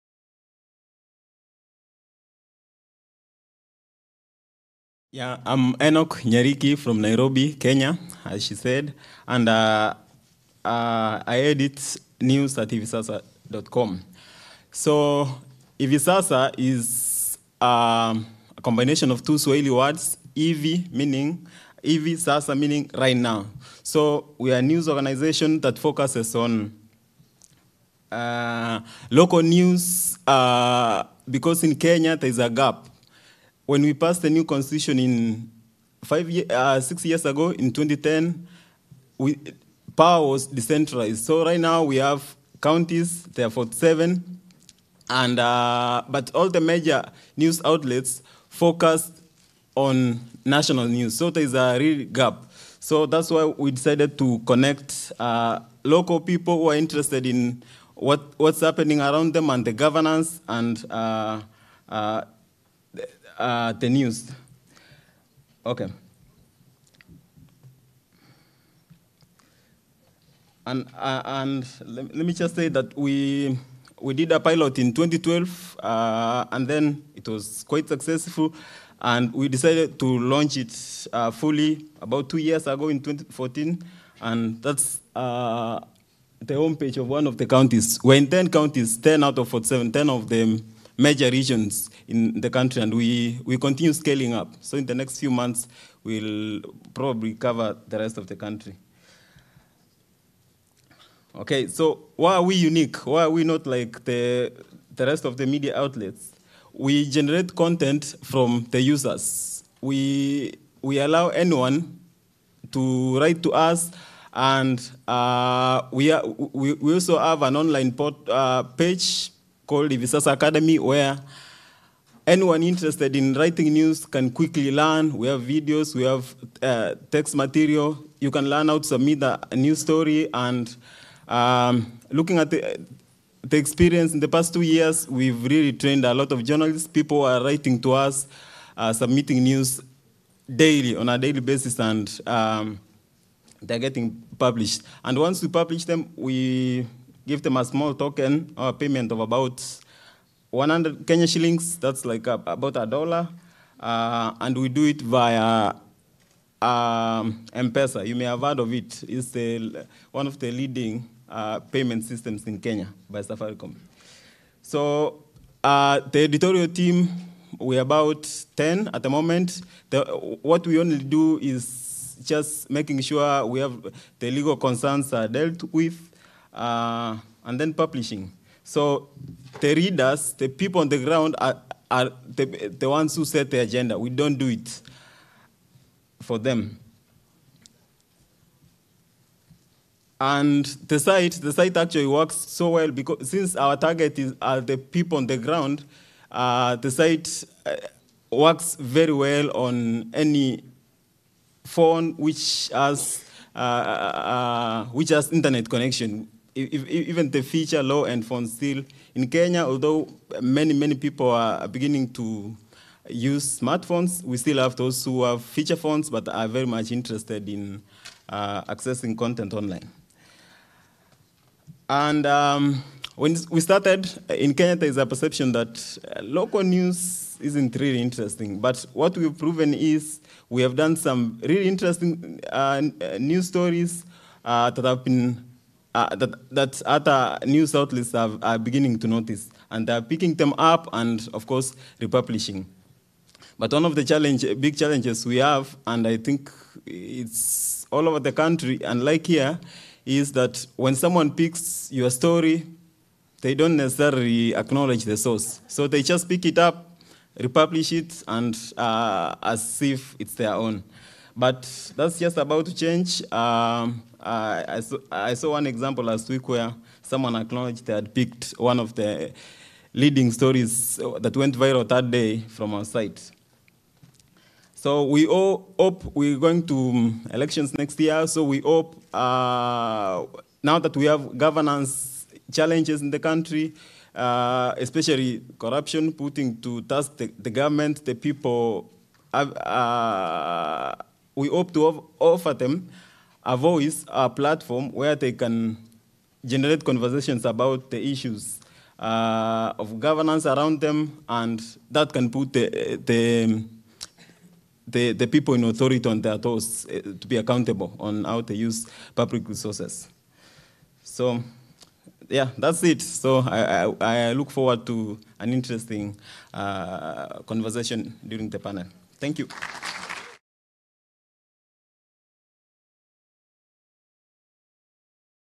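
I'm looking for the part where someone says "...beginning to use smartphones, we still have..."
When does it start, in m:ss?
3:31.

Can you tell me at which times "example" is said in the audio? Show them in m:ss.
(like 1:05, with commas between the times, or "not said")
4:25.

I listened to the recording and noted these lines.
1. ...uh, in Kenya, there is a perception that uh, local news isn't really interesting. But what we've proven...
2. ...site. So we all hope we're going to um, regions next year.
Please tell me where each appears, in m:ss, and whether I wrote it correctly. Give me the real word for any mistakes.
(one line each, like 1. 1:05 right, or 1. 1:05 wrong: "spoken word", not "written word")
1. 3:44 right
2. 4:32 wrong: "elections", not "regions".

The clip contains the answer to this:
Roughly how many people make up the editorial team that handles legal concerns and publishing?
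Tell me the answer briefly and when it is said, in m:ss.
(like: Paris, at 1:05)
10, at 2:47.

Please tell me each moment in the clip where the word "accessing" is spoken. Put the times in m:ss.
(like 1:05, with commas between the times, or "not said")
3:38.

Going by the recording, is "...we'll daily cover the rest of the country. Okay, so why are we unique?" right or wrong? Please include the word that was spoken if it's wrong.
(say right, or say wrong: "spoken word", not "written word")
wrong: "probably", not "daily".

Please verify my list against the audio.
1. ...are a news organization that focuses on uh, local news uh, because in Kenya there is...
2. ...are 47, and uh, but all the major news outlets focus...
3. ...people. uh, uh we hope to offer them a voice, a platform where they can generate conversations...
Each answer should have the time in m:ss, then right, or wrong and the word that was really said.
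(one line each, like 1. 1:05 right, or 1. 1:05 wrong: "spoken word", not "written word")
1. 0:24 right
2. 0:43 right
3. 4:48 right.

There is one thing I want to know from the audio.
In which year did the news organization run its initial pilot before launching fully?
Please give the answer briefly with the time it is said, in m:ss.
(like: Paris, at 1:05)
2012, at 1:14.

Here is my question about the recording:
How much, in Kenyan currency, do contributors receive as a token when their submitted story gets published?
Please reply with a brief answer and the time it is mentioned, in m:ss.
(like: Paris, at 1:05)
100 Kenya shillings, at 2:30.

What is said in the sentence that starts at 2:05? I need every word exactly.
We have videos, we have uh, text material.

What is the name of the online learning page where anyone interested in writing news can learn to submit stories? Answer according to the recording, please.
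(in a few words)
Hivisasa Academy.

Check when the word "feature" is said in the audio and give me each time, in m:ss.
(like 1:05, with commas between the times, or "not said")
3:27, 3:35.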